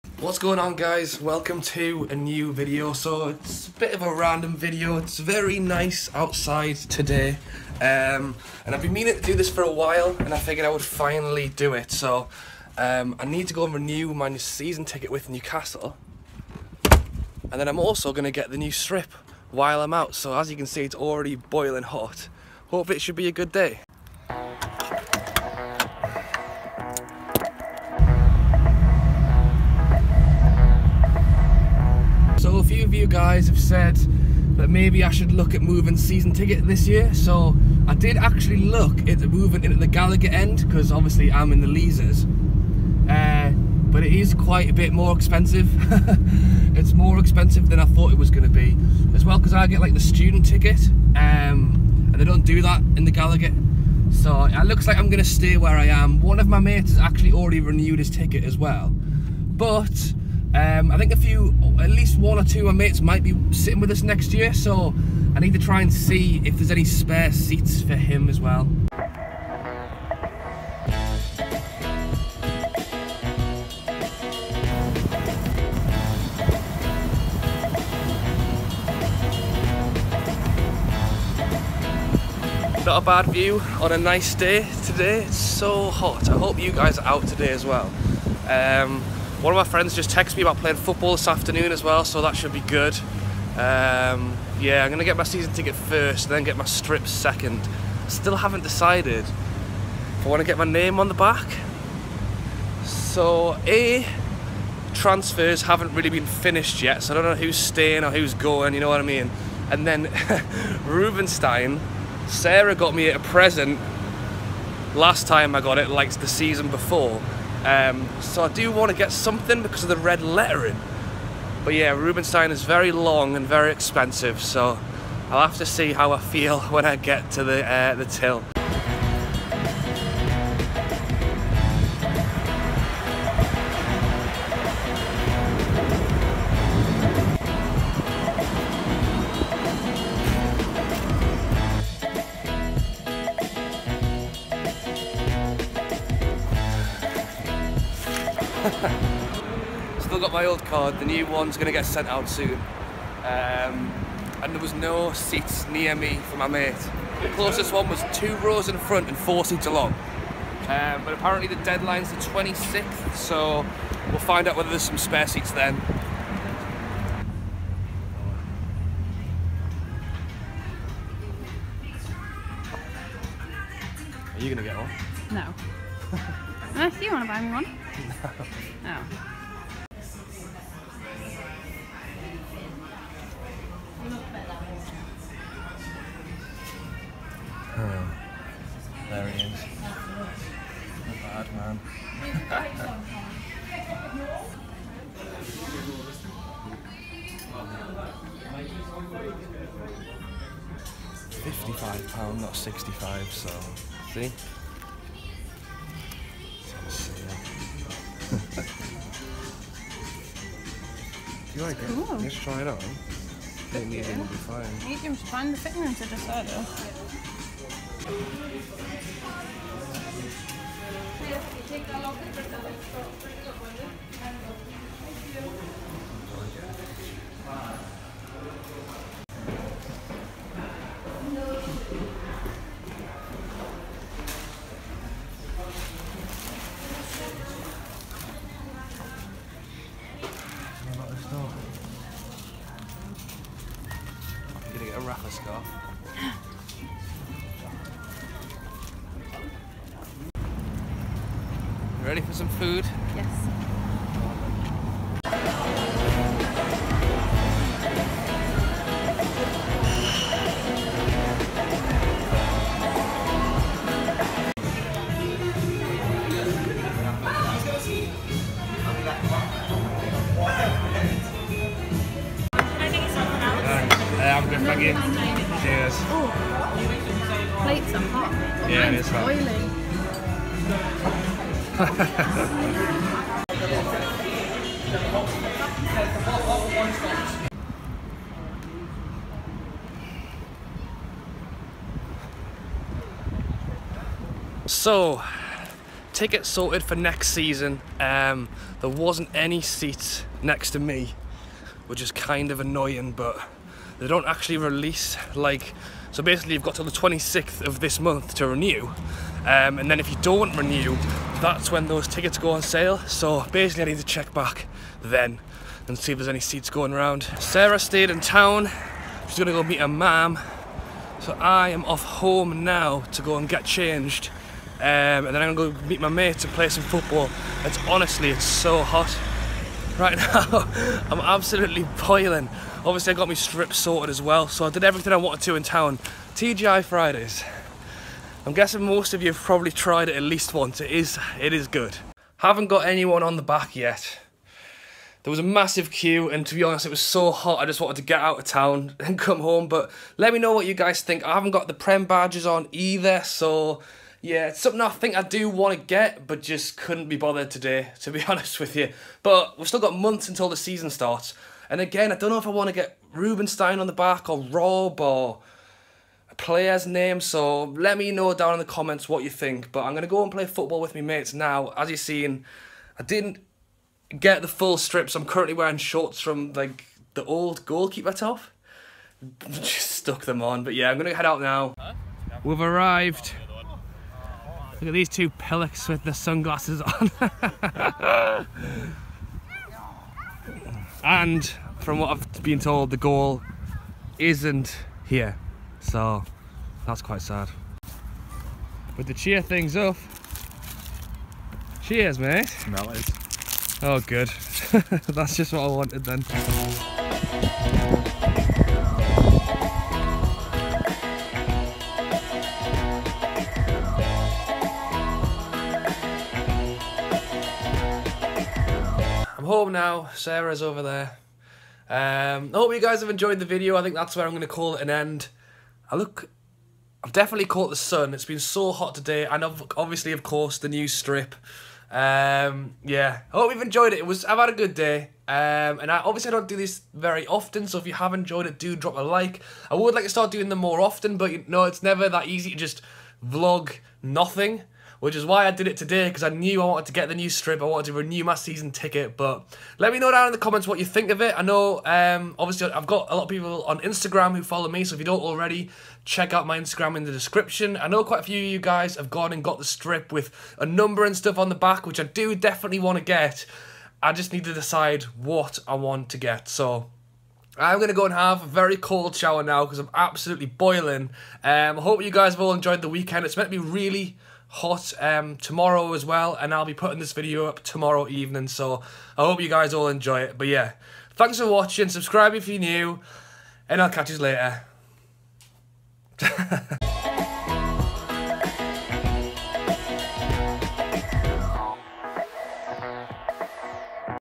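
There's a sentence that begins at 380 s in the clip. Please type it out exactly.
But yeah, I'm going to head out now.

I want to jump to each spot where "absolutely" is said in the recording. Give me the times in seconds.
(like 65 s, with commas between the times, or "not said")
331 s, 469 s.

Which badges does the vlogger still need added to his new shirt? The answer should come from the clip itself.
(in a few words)
Prem badges.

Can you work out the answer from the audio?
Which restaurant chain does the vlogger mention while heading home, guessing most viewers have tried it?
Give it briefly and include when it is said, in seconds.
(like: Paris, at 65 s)
TGI Fridays, at 336 s.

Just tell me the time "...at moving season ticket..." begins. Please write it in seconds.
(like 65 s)
35 s.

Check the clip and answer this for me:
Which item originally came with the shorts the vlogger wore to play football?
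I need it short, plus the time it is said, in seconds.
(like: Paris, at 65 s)
old goalkeeper top, at 377 s.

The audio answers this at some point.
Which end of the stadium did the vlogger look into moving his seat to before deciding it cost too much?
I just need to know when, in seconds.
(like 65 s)
39 s.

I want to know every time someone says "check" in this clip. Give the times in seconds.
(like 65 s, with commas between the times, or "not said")
314 s, 456 s.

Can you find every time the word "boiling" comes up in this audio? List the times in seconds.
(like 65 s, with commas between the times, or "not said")
21 s, 332 s, 470 s.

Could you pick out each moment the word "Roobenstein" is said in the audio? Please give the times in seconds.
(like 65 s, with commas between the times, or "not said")
110 s, 121 s, 363 s.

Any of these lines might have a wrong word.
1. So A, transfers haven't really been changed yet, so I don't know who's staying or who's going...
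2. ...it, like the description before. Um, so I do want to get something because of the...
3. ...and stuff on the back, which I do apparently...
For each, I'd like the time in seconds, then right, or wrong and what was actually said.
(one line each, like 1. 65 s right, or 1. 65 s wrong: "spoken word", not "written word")
1. 102 s wrong: "finished", not "changed"
2. 115 s wrong: "season", not "description"
3. 461 s wrong: "definitely", not "apparently".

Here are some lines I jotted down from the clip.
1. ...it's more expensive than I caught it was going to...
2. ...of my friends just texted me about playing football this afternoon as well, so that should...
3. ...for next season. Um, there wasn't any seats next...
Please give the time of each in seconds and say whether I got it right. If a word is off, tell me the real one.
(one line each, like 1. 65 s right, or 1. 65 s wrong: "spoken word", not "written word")
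1. 46 s wrong: "thought", not "caught"
2. 89 s right
3. 296 s right.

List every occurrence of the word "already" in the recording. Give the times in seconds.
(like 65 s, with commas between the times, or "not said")
20 s, 57 s, 455 s.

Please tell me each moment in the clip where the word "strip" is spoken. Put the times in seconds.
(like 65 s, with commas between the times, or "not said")
18 s, 96 s, 333 s, 374 s, 430 s, 447 s, 459 s.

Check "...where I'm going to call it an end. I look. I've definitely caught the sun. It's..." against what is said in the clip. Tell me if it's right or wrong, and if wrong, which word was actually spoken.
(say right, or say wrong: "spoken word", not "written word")
right.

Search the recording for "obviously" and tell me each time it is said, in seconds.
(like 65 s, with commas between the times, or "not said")
40 s, 332 s, 429 s, 435 s, 452 s.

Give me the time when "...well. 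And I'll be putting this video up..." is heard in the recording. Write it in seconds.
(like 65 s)
476 s.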